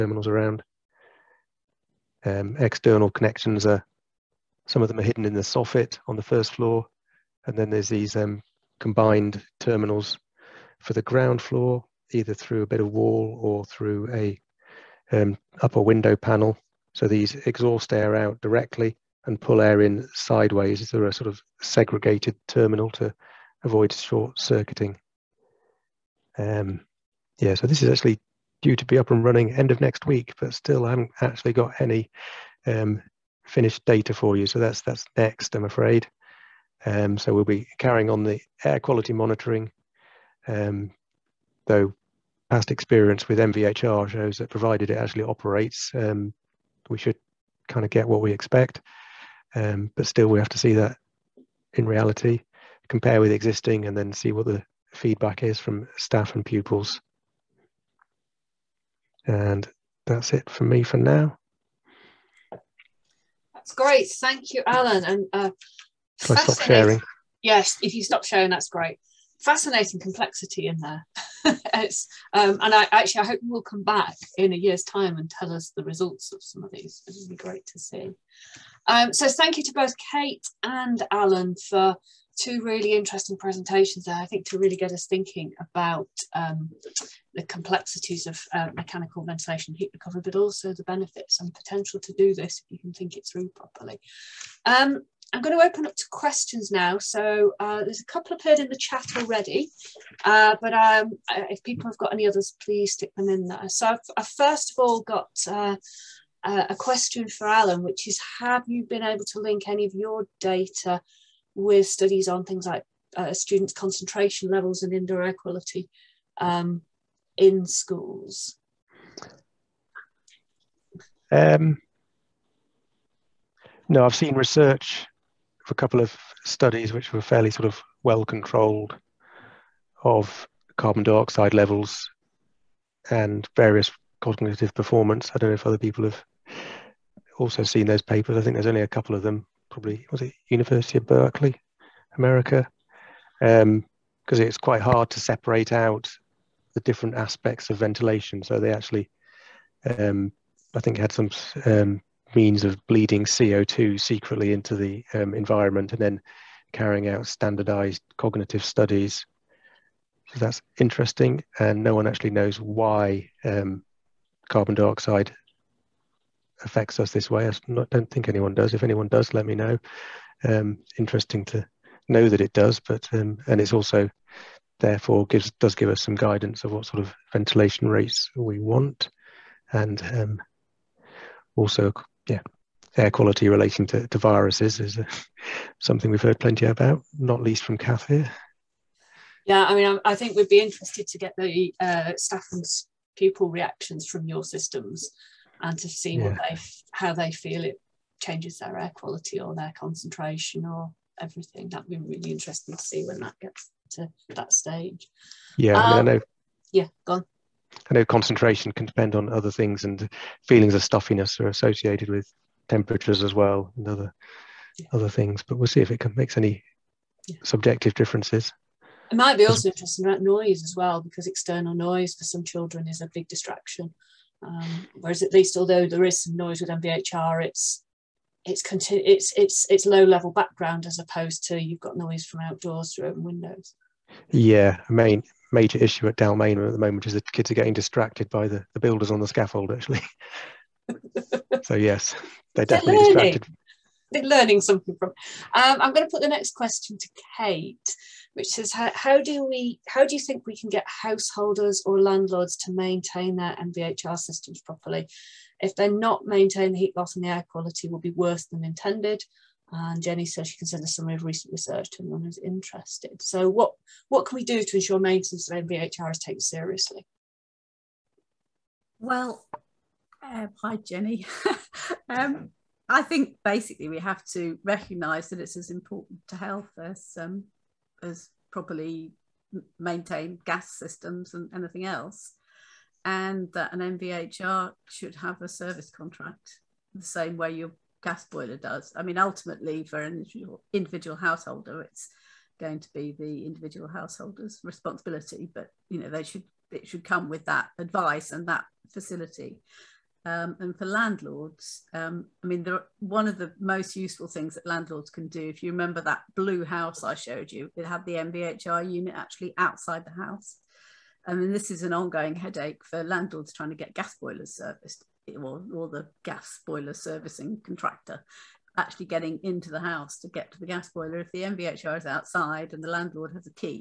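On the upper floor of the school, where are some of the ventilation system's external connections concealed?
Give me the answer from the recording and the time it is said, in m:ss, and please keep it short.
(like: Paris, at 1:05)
In the soffit, at 0:05.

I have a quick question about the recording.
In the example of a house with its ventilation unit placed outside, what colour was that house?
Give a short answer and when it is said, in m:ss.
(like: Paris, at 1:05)
Blue, at 5:06.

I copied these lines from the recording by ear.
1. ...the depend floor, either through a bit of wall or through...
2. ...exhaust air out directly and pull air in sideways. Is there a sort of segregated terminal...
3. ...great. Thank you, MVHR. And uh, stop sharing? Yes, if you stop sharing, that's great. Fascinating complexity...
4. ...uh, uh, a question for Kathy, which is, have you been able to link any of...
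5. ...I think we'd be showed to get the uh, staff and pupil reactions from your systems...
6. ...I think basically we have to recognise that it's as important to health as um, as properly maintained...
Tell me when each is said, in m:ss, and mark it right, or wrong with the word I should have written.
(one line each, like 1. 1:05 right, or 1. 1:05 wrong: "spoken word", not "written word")
1. 0:10 wrong: "ground", not "depend"
2. 0:17 right
3. 1:03 wrong: "Alan", not "MVHR"
4. 1:45 wrong: "Alan", not "Kathy"
5. 3:10 wrong: "interested", not "showed"
6. 4:32 right.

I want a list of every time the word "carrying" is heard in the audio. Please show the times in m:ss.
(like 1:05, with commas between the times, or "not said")
0:37, 2:36.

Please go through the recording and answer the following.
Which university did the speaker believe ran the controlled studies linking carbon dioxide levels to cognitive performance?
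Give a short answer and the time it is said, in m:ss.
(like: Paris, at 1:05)
University of Berkeley, at 2:20.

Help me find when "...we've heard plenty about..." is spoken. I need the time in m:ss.
3:06.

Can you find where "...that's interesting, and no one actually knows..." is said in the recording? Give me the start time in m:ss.
2:40.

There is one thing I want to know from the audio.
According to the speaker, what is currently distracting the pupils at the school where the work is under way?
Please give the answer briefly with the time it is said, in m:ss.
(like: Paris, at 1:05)
The builders on the scaffold, at 3:58.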